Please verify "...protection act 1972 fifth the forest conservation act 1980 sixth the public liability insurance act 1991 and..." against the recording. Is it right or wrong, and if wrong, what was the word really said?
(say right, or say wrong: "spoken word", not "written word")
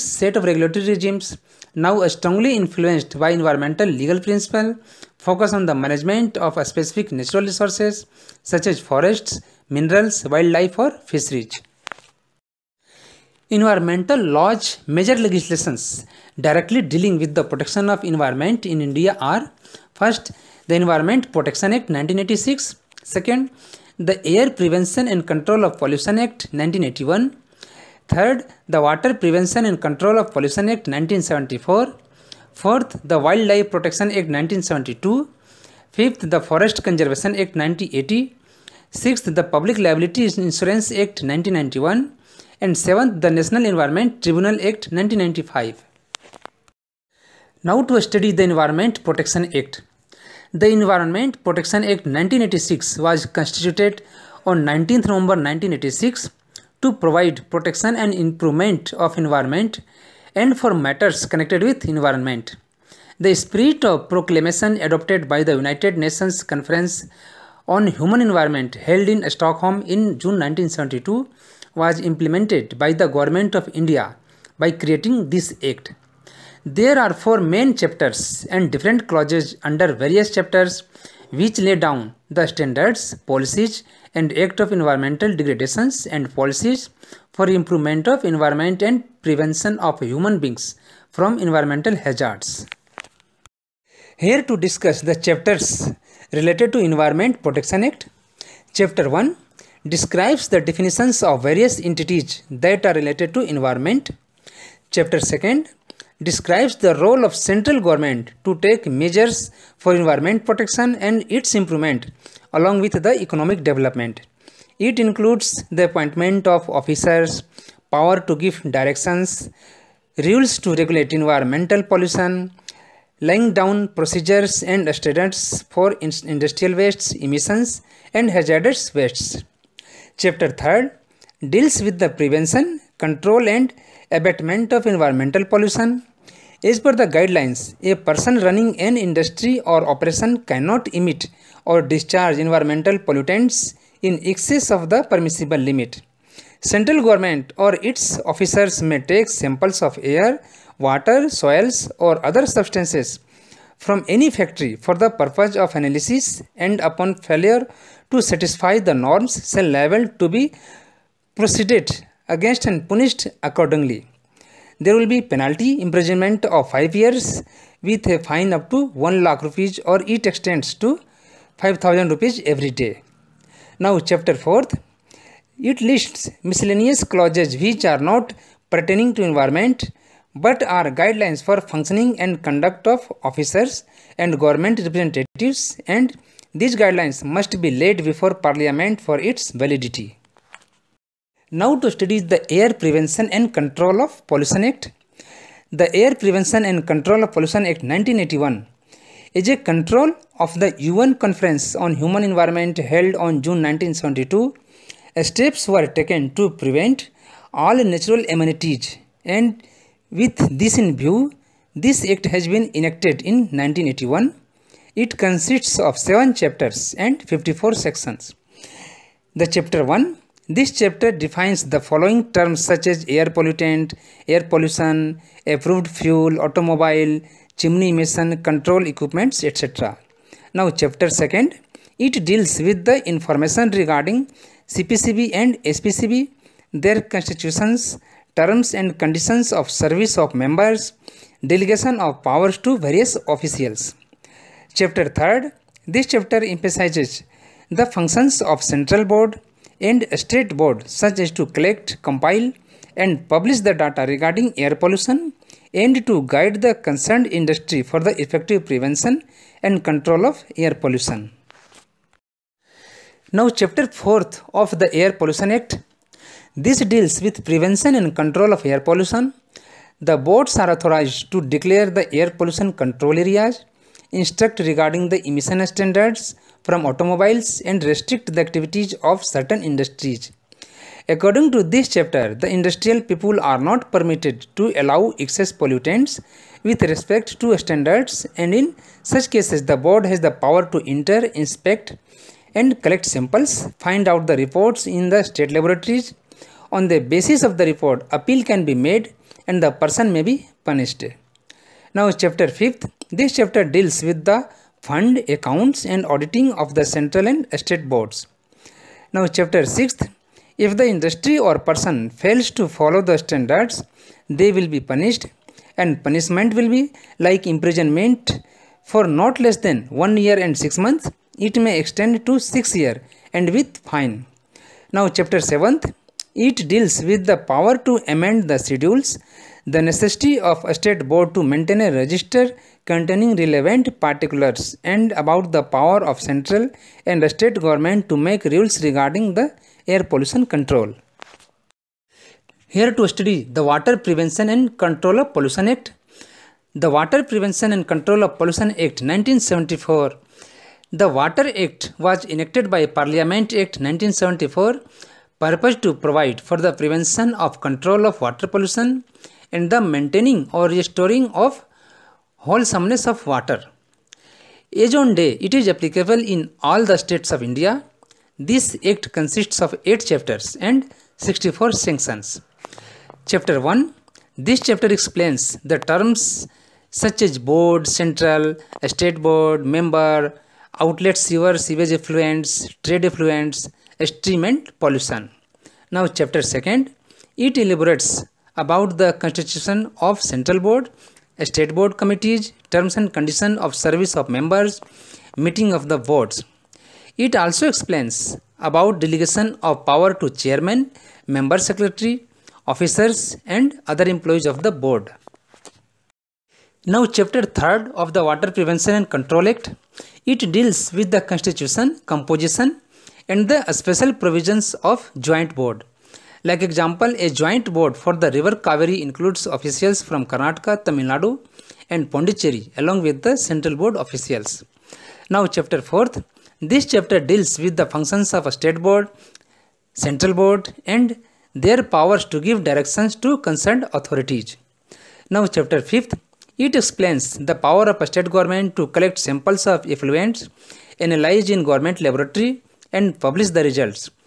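right.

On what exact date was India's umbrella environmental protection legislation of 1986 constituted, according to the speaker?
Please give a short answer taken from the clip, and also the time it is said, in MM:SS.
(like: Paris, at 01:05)
19 November 1986, at 00:54.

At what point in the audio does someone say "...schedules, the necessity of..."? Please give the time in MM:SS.
05:28.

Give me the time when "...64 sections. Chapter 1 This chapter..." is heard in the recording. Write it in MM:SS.
06:11.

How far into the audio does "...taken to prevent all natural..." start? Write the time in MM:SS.
03:25.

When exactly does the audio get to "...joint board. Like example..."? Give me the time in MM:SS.
06:55.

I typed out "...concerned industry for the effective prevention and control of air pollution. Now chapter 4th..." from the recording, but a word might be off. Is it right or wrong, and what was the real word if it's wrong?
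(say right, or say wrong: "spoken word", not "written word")
right.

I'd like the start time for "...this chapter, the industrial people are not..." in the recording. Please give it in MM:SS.
04:41.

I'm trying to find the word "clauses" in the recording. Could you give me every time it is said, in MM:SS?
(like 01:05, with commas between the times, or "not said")
01:19, 02:57.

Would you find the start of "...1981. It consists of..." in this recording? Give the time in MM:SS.
03:33.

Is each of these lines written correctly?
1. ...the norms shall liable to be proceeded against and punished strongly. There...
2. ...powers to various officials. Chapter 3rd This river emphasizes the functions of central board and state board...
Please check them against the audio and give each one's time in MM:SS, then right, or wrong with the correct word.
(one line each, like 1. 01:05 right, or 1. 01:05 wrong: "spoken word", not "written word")
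1. 02:38 wrong: "accordingly", not "strongly"
2. 04:02 wrong: "chapter", not "river".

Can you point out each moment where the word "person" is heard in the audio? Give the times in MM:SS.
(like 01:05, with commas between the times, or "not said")
02:17, 04:59, 05:11.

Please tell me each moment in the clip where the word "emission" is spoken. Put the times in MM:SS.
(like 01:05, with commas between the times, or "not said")
02:07, 03:47, 04:35.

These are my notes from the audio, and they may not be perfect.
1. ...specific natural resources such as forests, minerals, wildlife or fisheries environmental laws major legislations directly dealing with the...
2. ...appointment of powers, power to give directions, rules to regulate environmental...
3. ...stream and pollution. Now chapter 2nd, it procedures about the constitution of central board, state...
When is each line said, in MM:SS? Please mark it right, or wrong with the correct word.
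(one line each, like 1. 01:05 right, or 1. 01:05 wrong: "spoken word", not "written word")
1. 00:06 right
2. 01:55 wrong: "officers", not "powers"
3. 06:24 wrong: "elaborates", not "procedures".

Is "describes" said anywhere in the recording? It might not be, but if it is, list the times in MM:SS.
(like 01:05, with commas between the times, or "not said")
01:39, 01:46.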